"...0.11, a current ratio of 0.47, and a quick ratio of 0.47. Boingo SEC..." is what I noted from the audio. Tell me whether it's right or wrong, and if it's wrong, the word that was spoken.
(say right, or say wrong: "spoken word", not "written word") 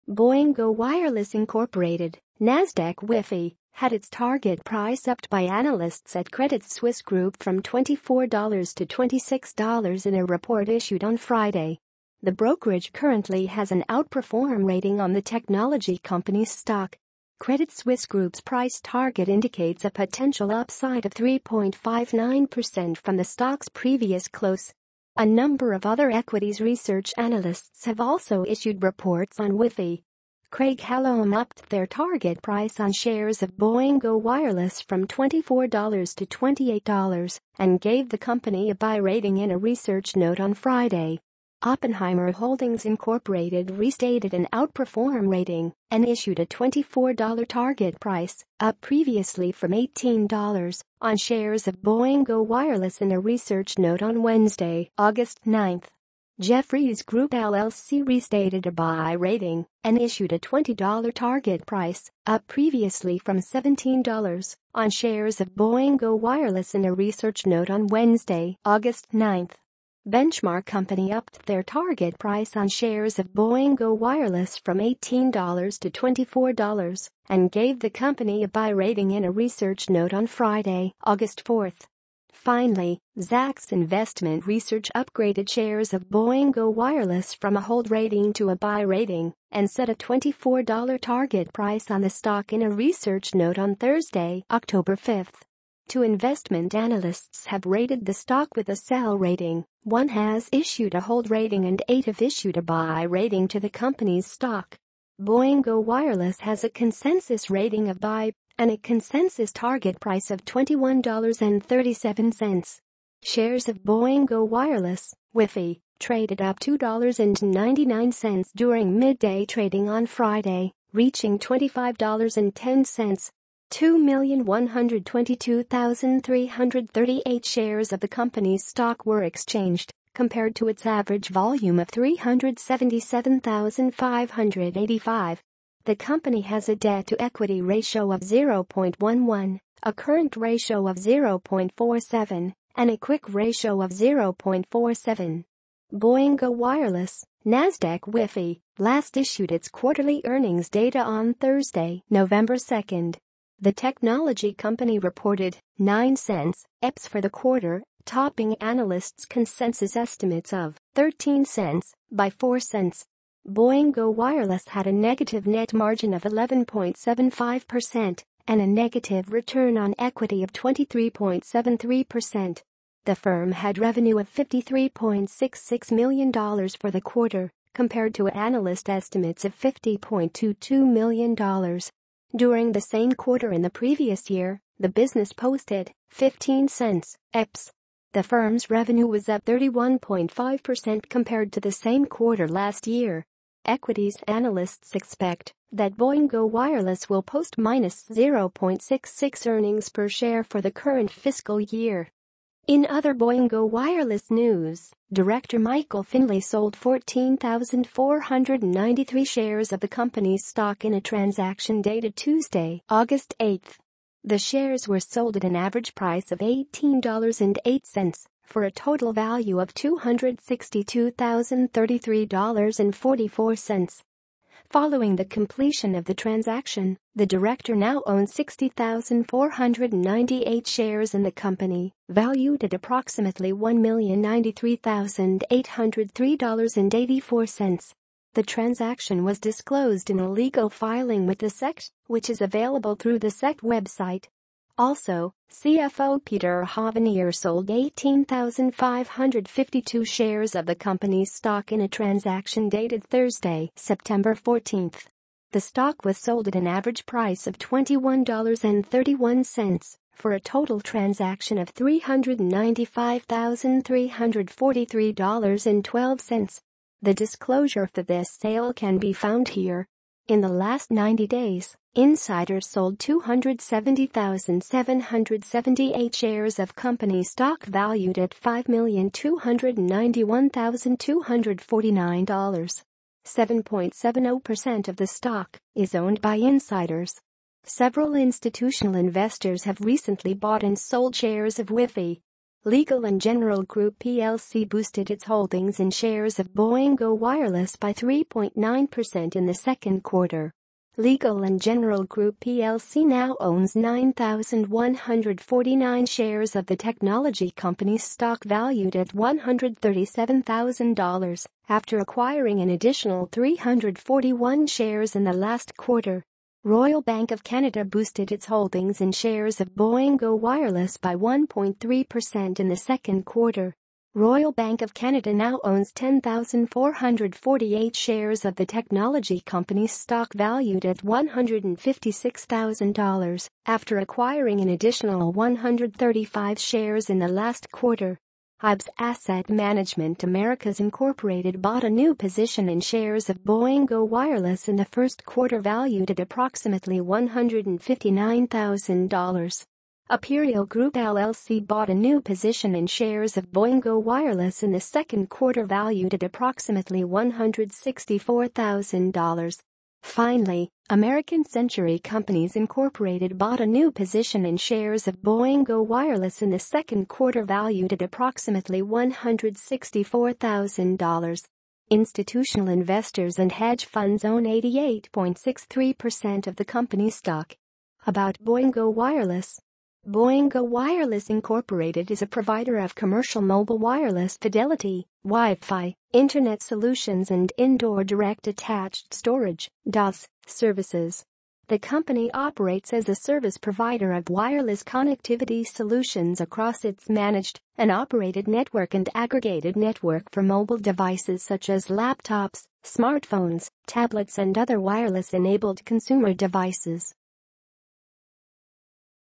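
wrong: "Wireless", not "SEC".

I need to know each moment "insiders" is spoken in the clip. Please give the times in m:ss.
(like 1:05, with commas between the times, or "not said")
4:31, 4:46.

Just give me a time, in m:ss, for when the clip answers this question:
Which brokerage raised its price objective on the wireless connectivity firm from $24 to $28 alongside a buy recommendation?
0:30.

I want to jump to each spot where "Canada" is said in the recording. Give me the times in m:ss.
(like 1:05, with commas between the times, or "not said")
5:17, 5:24.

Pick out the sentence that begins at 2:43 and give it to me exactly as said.
Boingo Wireless had a negative net margin of 11.75% and a negative return on equity of 23.73%.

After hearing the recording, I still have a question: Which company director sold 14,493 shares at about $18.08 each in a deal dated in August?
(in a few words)
Michael Finley.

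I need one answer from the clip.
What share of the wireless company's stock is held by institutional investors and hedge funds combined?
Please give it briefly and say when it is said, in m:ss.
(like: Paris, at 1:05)
88.63%, at 6:14.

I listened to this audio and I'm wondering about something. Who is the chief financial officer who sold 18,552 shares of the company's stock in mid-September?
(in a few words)
Peter Hovenier.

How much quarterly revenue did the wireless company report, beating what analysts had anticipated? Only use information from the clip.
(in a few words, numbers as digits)
$53.66 million.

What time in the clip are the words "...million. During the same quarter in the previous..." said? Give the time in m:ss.
3:00.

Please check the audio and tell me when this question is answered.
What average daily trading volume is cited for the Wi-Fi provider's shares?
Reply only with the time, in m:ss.
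2:11.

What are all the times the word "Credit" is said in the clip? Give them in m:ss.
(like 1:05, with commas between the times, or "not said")
0:06, 0:17.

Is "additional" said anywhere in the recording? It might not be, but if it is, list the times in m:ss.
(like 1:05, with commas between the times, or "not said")
5:12, 5:34.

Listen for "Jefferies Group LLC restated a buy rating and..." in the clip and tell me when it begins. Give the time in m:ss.
0:56.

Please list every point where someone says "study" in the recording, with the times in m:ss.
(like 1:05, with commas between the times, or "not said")
not said.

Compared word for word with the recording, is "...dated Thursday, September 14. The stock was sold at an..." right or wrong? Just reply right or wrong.
right.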